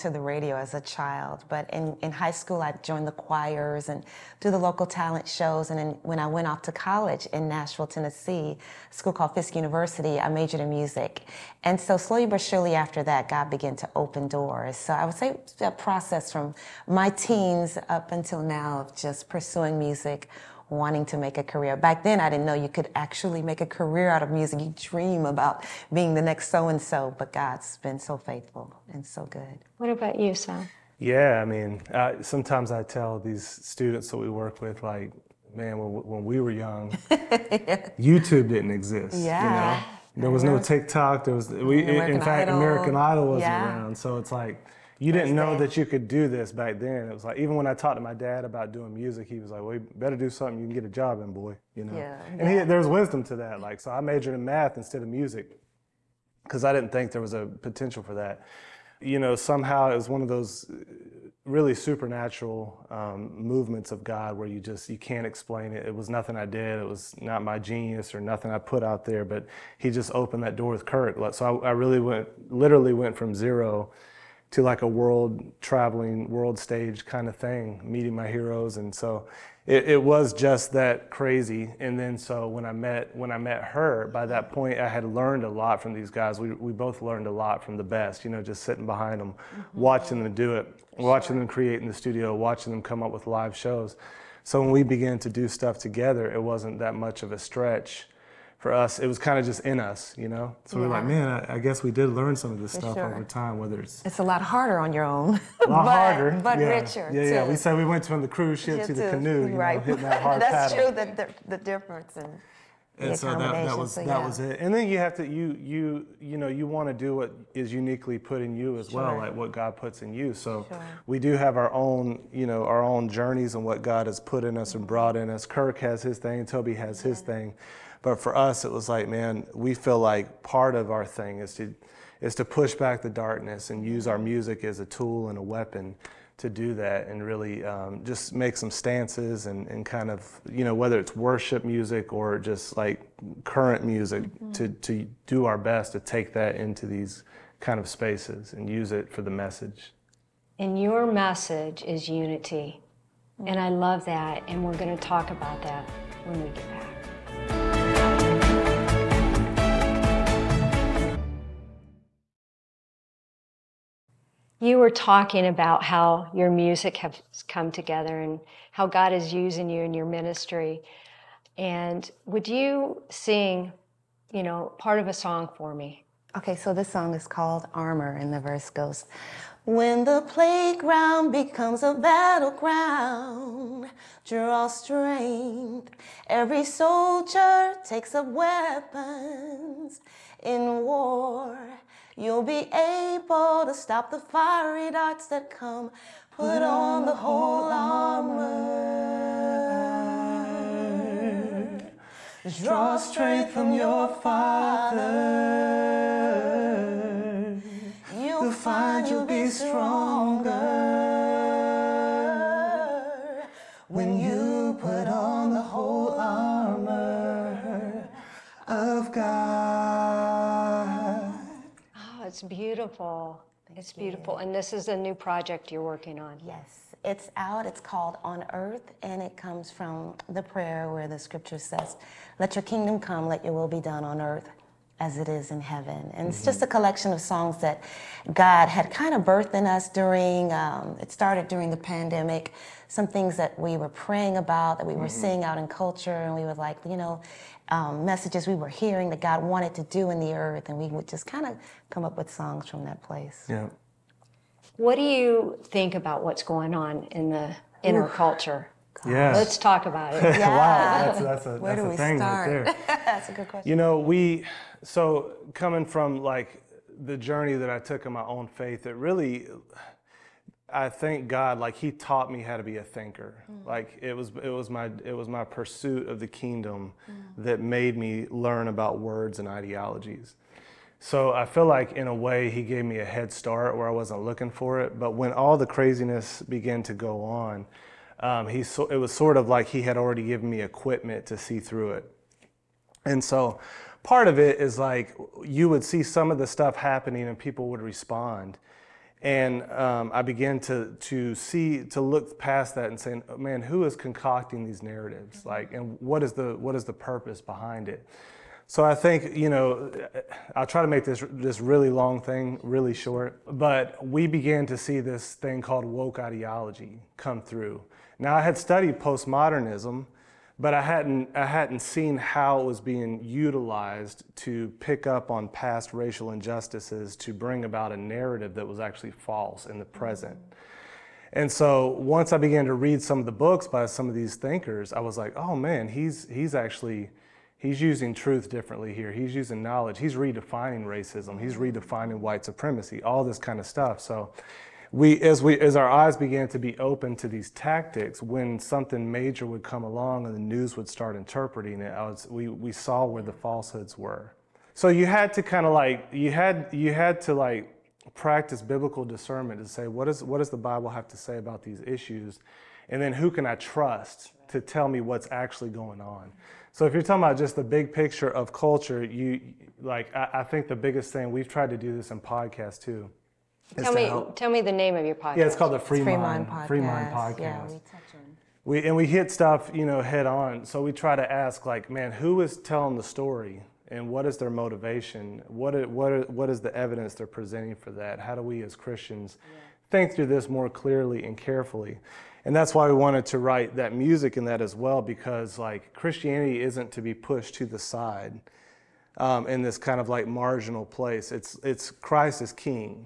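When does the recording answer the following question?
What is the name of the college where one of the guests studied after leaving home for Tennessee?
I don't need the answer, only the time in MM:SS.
00:09.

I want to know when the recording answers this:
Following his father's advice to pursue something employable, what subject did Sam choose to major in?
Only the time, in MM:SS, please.
00:54.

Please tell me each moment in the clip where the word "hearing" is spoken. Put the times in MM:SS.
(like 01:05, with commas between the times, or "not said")
04:08.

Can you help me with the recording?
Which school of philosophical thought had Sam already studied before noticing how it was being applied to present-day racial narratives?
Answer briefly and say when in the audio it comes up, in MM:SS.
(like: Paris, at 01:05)
Postmodernism, at 05:18.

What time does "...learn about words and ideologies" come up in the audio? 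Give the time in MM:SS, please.
04:38.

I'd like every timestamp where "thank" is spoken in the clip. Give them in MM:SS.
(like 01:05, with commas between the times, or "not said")
03:43, 04:30.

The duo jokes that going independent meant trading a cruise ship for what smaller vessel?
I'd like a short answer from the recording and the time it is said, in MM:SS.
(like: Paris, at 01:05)
Canoe, at 01:49.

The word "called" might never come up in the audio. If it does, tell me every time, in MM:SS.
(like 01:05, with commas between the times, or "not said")
00:09, 02:57, 03:47, 05:15, 06:15.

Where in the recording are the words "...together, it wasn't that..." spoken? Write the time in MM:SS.
01:35.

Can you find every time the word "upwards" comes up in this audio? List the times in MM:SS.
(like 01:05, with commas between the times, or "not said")
not said.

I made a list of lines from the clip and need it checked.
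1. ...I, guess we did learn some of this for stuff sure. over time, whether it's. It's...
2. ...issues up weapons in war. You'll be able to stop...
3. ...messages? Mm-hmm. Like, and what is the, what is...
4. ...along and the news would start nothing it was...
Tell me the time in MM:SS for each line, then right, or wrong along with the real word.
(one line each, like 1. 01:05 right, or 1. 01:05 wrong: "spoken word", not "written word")
1. 01:41 right
2. 03:07 wrong: "takes", not "issues"
3. 05:04 wrong: "narratives", not "messages"
4. 05:49 wrong: "interpreting", not "nothing".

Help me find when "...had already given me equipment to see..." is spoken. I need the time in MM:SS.
04:49.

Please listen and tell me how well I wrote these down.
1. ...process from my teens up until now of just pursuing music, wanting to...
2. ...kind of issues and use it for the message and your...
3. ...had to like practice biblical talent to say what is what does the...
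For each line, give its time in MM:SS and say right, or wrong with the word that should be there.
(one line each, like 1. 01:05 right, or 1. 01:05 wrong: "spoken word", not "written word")
1. 00:15 right
2. 02:27 wrong: "spaces", not "issues"
3. 05:56 wrong: "discernment", not "talent".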